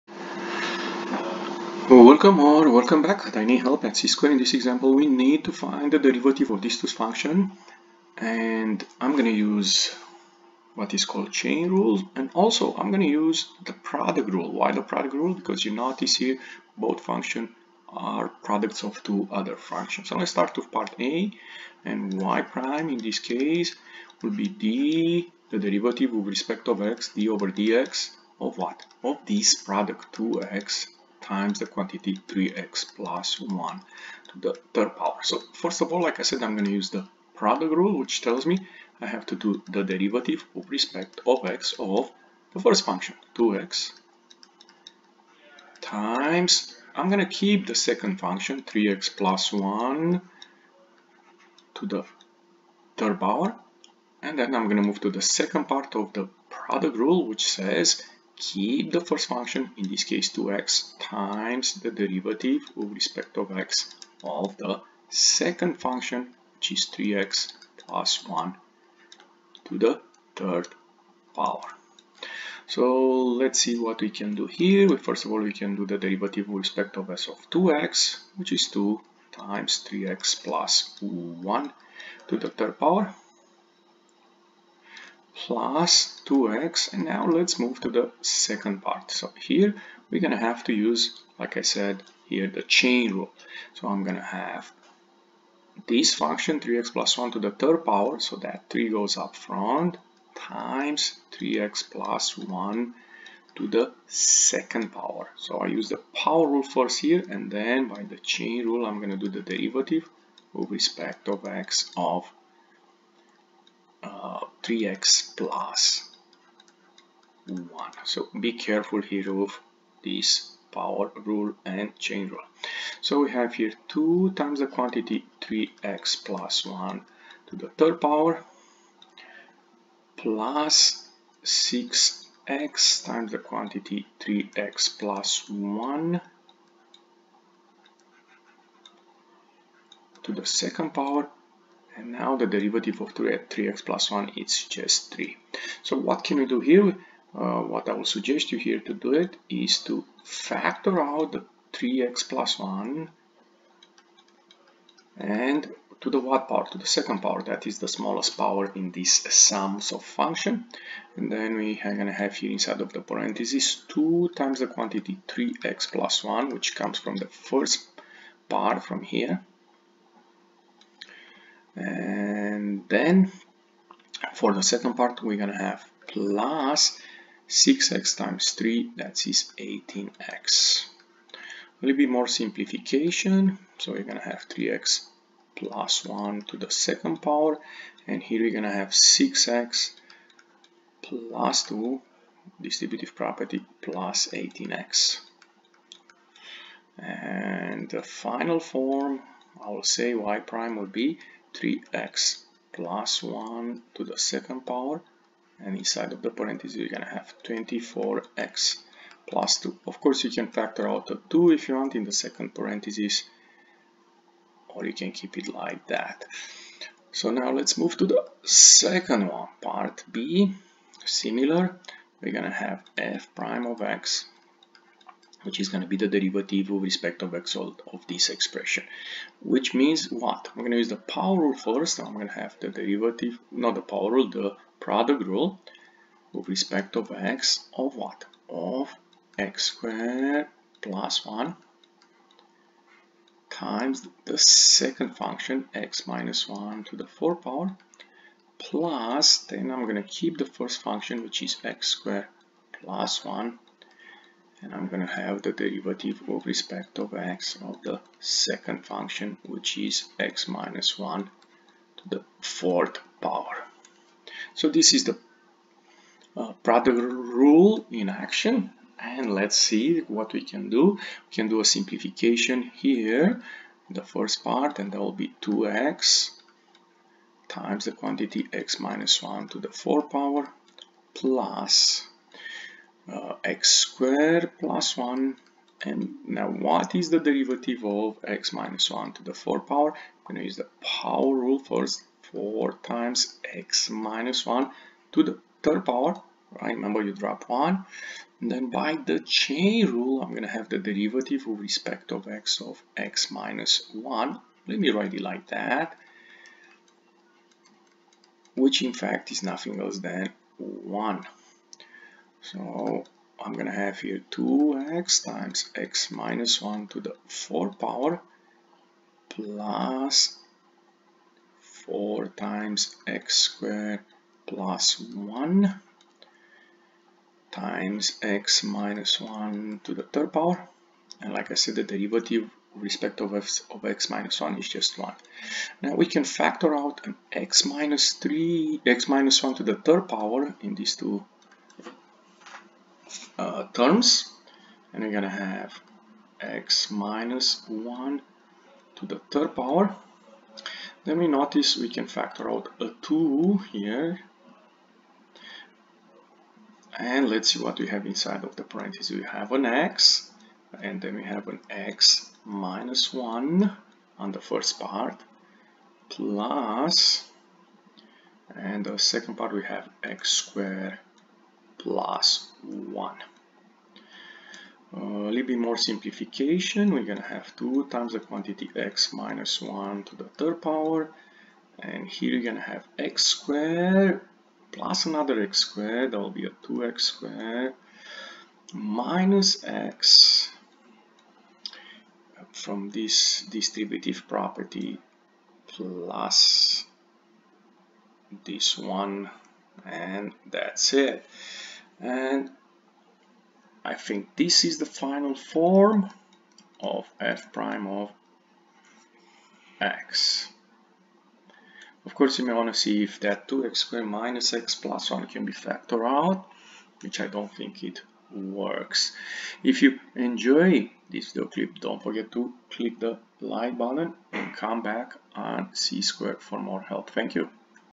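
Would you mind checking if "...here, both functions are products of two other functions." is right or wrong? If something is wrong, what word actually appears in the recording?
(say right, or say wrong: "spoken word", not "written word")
right.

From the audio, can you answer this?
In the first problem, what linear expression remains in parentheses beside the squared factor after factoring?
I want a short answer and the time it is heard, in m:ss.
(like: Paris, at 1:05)
24x + 2, at 3:27.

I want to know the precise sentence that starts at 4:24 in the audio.
So this is the uh, product rule in action and let's see what we can do.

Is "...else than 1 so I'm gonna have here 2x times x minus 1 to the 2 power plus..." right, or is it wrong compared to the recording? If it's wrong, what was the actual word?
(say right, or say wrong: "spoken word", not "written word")
wrong: "4", not "2".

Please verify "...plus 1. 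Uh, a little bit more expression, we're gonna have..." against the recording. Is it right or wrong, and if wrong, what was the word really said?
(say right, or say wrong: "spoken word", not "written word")
wrong: "simplification", not "expression".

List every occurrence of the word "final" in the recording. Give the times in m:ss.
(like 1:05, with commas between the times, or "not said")
3:18, 6:44.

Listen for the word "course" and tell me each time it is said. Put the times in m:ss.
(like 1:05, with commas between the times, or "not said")
3:29, 6:52.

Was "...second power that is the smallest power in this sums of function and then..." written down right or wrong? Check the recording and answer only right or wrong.
right.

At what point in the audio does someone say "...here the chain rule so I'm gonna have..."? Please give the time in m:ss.
1:32.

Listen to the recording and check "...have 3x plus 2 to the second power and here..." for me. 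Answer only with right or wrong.
wrong.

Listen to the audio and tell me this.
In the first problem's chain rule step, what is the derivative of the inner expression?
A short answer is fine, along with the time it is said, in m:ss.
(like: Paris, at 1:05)
3, at 2:22.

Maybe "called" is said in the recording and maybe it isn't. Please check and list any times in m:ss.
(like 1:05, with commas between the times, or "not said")
0:11.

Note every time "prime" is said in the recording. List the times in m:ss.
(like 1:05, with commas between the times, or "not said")
0:22, 3:20, 3:43, 6:47.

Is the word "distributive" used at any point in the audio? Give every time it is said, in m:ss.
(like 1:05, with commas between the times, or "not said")
3:12, 6:33.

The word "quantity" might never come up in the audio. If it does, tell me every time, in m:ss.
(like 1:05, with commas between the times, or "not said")
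0:31, 2:04, 2:13, 2:44, 4:37, 6:18.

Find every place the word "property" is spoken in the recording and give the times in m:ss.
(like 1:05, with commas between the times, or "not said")
3:13, 6:34.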